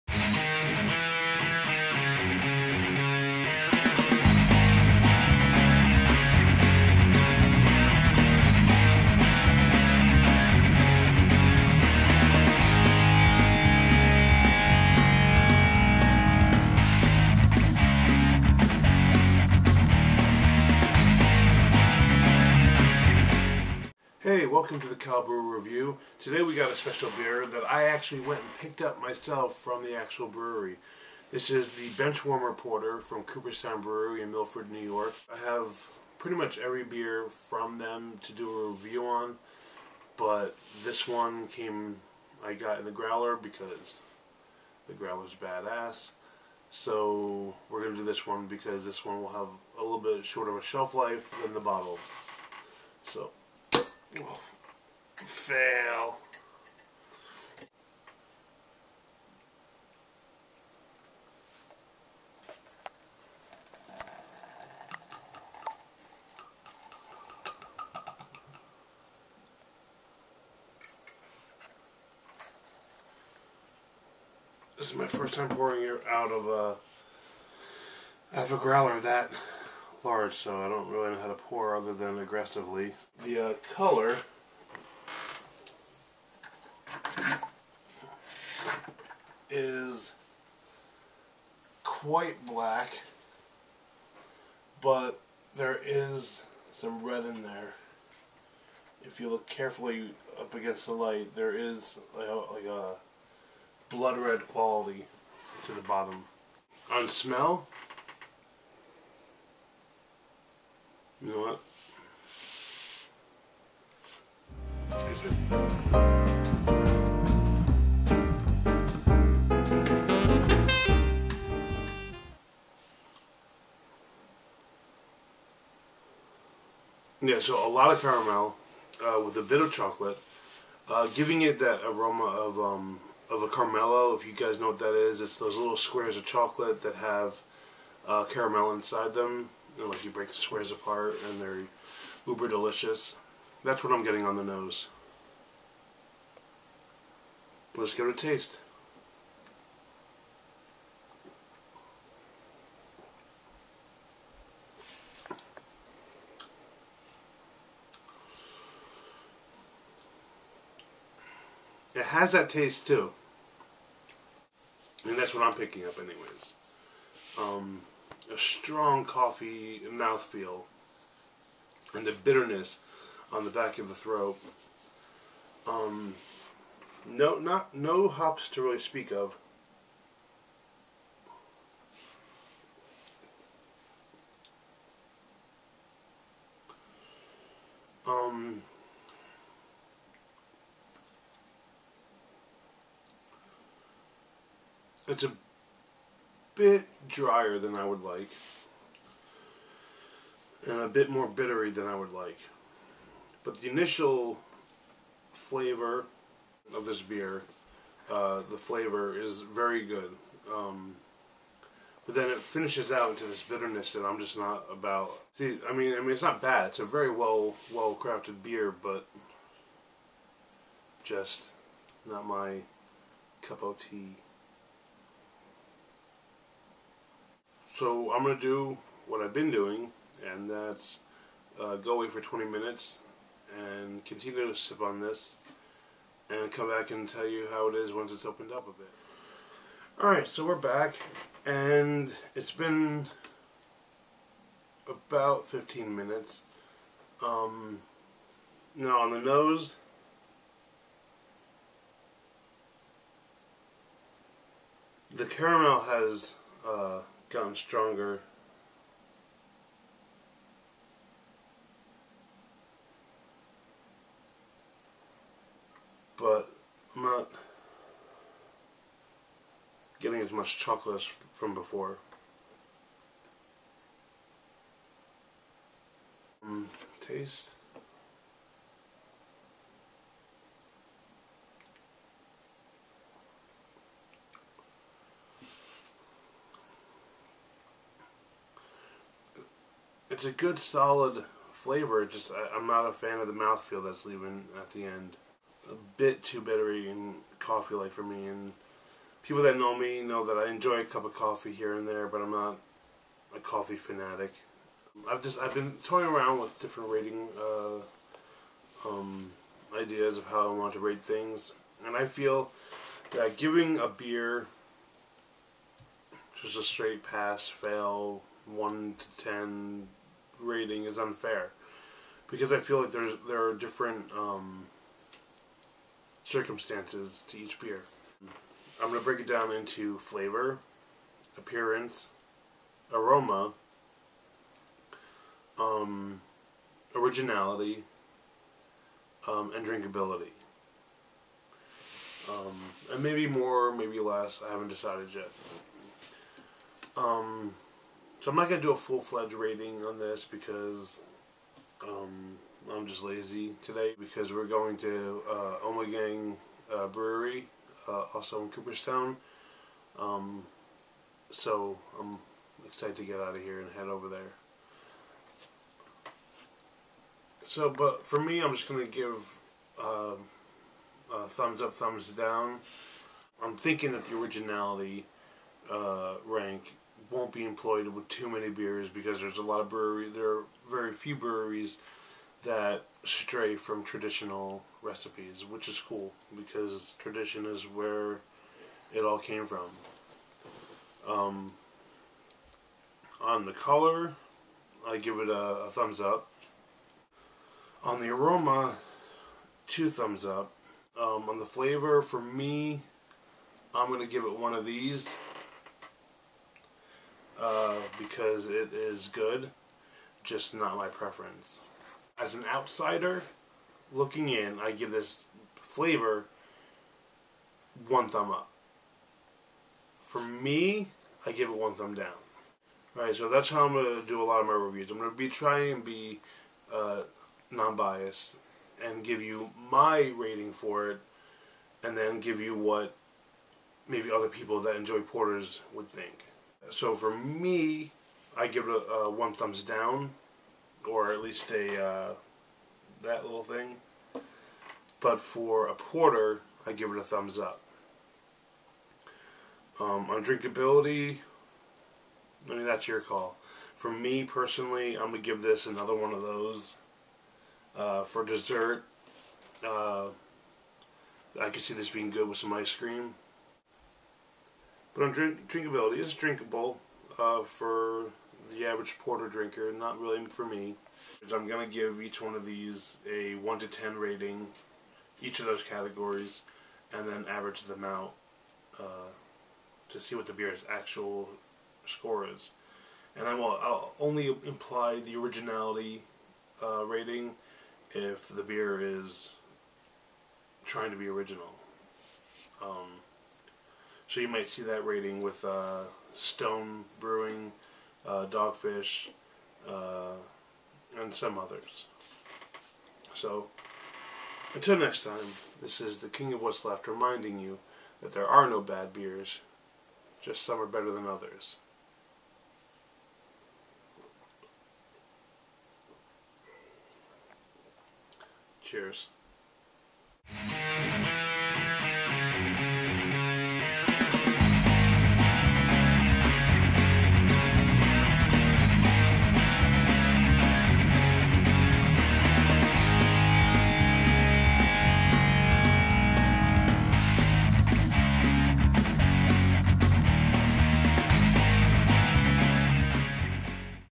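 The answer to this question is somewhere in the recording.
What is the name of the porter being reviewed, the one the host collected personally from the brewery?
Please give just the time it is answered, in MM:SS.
00:32.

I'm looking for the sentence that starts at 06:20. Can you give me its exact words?
There are very few breweries that stray from traditional recipes, which is cool because tradition is where it all came from.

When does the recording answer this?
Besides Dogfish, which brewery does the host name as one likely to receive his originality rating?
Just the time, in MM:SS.
08:16.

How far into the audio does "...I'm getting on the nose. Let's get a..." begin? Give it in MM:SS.
02:23.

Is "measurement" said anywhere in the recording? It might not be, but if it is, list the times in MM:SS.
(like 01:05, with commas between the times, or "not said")
not said.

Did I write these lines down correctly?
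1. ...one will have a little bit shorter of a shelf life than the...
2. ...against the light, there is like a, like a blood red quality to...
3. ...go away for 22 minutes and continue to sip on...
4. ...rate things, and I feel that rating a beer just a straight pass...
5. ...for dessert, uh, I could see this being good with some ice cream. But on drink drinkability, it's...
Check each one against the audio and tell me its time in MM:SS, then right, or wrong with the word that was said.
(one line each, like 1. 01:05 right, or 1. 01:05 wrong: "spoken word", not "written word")
1. 00:49 right
2. 01:40 right
3. 03:51 wrong: "20", not "22"
4. 05:10 wrong: "giving", not "rating"
5. 07:38 right.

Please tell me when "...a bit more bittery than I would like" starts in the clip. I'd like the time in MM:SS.
03:20.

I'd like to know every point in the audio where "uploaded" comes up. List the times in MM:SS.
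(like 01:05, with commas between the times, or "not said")
not said.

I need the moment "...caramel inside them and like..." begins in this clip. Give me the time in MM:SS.
02:18.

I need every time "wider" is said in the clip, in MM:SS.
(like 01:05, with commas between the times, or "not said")
not said.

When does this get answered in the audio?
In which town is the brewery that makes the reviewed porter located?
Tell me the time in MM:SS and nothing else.
00:34.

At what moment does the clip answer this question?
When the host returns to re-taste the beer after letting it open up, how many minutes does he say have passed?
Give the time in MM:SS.
04:05.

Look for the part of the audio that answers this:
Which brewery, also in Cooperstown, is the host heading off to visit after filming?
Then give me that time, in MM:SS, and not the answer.
05:55.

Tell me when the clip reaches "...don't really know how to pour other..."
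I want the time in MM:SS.
01:20.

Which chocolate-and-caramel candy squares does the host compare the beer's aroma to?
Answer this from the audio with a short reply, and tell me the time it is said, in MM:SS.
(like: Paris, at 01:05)
Caramello, at 02:13.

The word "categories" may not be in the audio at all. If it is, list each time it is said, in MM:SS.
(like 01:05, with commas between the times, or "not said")
07:55.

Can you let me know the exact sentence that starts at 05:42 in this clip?
Um, and maybe more, maybe less.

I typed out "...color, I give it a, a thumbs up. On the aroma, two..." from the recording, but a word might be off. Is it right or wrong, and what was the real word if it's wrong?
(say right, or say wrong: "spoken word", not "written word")
right.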